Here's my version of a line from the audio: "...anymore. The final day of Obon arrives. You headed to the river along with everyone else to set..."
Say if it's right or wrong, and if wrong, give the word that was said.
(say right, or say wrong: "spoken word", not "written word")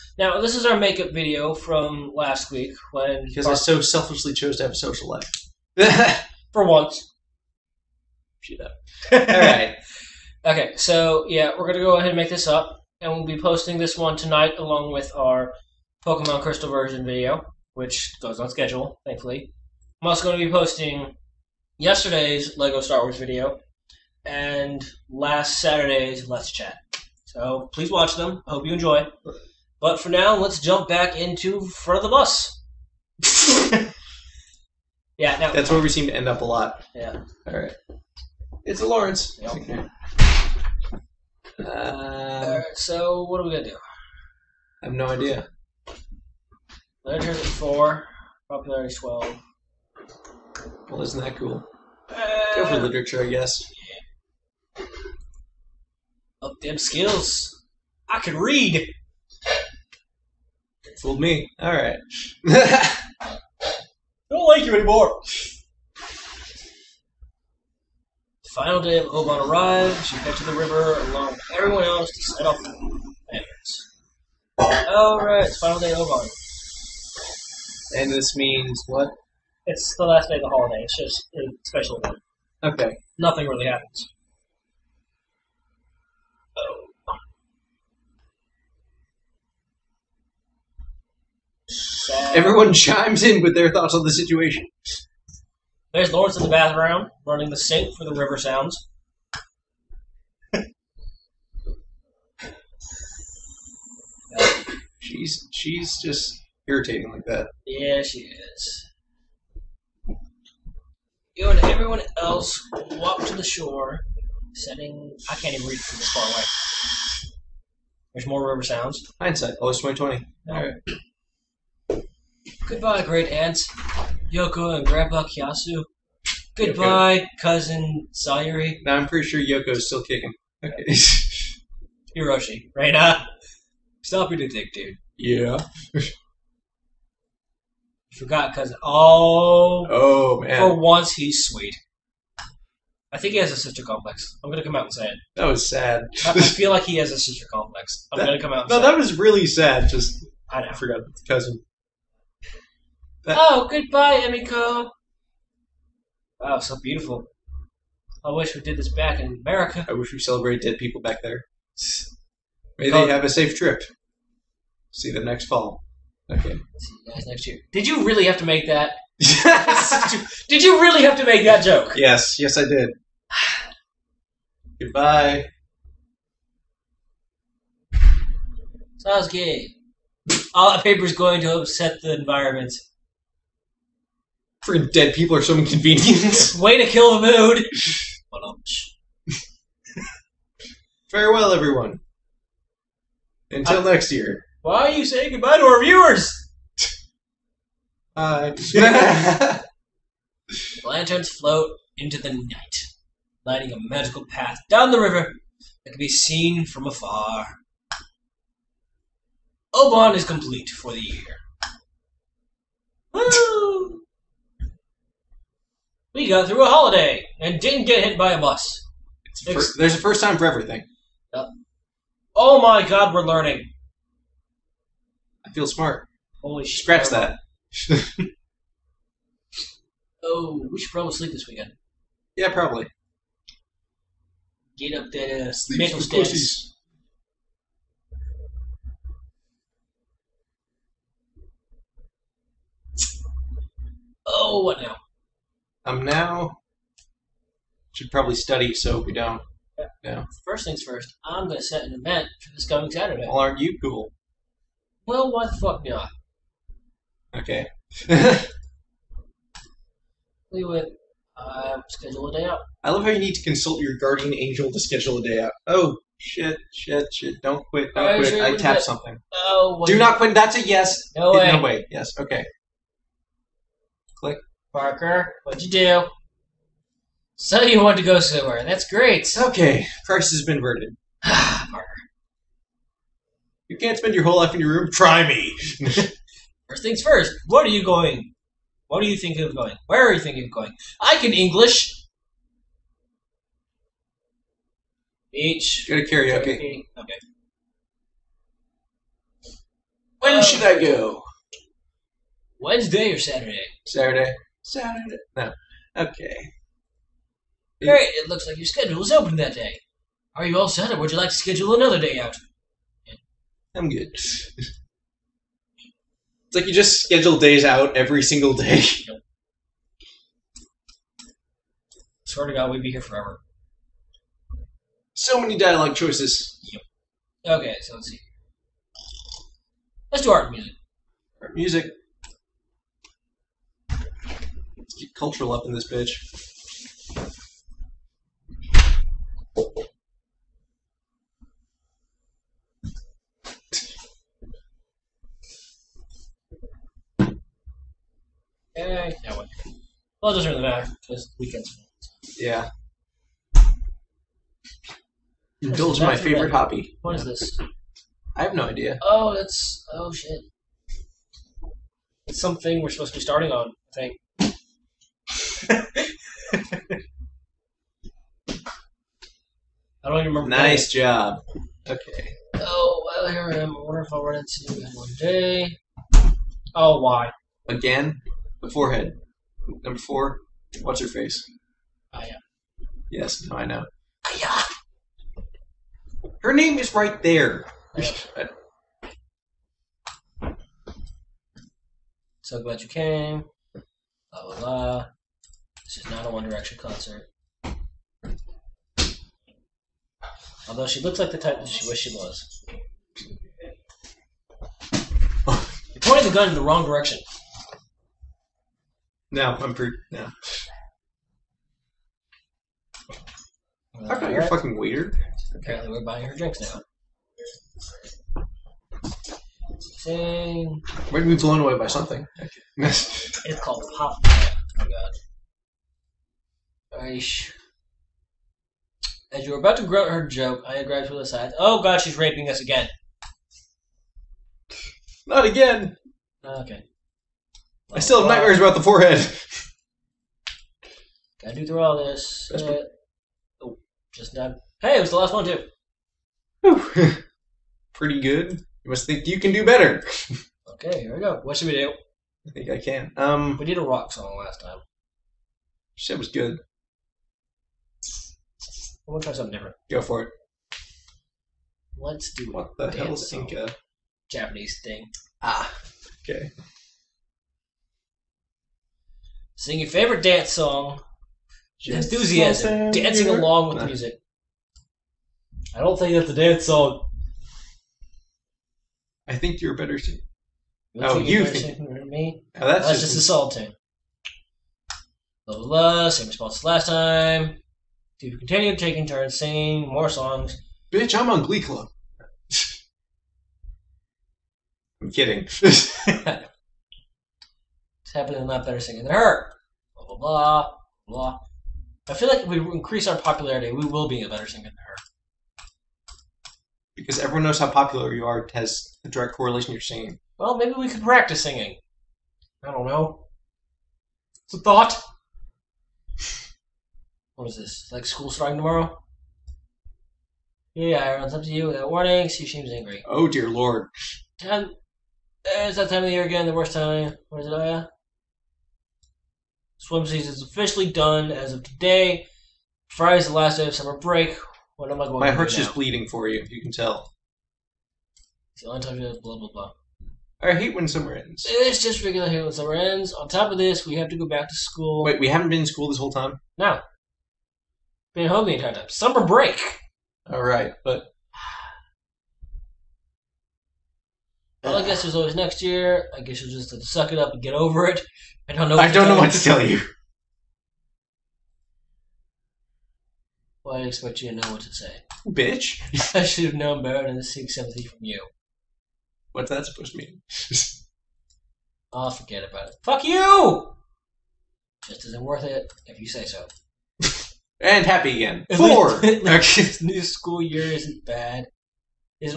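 right.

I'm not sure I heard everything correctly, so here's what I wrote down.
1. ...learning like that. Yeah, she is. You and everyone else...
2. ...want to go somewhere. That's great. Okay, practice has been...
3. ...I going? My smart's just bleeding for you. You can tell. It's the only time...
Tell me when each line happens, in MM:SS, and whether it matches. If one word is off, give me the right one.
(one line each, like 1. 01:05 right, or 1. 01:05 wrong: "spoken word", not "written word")
1. 01:46 wrong: "irritating", not "learning"
2. 04:37 wrong: "price", not "practice"
3. 08:54 wrong: "heart", not "smart".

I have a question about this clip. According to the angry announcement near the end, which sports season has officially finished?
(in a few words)
Swim season.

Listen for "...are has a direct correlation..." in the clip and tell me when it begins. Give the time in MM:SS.
08:28.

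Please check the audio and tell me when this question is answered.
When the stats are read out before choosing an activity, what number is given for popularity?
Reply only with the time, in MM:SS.
00:48.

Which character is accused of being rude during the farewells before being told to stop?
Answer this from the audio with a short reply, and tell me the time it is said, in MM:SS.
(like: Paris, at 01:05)
Hiroshi, at 02:12.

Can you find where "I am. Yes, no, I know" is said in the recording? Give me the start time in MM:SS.
06:22.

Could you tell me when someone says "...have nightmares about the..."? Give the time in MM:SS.
07:18.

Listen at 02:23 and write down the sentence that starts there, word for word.
I think he has a sister complex.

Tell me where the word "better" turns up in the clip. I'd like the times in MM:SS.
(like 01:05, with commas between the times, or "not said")
07:29, 07:59, 08:18, 08:24, 09:26.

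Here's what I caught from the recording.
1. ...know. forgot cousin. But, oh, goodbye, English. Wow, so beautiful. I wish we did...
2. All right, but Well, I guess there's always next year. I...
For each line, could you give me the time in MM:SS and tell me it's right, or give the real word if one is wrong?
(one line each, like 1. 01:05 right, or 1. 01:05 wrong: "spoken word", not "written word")
1. 02:30 wrong: "Emiko", not "English"
2. 09:10 right.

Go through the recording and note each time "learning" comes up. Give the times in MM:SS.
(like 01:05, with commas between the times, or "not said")
03:43.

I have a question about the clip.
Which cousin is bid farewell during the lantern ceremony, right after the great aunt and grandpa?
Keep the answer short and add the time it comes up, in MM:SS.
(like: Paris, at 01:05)
Sayuri, at 02:07.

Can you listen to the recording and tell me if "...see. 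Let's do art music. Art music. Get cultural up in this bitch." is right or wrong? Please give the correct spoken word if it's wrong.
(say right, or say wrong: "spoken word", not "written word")
right.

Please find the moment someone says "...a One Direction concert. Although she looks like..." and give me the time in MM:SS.
06:36.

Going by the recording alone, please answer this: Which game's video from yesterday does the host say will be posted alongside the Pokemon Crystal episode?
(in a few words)
Lego Star Wars.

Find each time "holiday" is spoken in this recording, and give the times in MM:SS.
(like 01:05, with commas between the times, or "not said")
01:20, 03:36.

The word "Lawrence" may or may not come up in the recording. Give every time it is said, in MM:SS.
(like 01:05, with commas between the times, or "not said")
00:38, 01:36.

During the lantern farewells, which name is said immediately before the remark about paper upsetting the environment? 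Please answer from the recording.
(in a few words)
Sasuke.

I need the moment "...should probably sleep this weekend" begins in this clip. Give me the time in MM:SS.
03:50.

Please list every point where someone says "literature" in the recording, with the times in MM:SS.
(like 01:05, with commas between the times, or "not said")
00:47, 00:52.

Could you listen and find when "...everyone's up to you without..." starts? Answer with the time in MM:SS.
08:40.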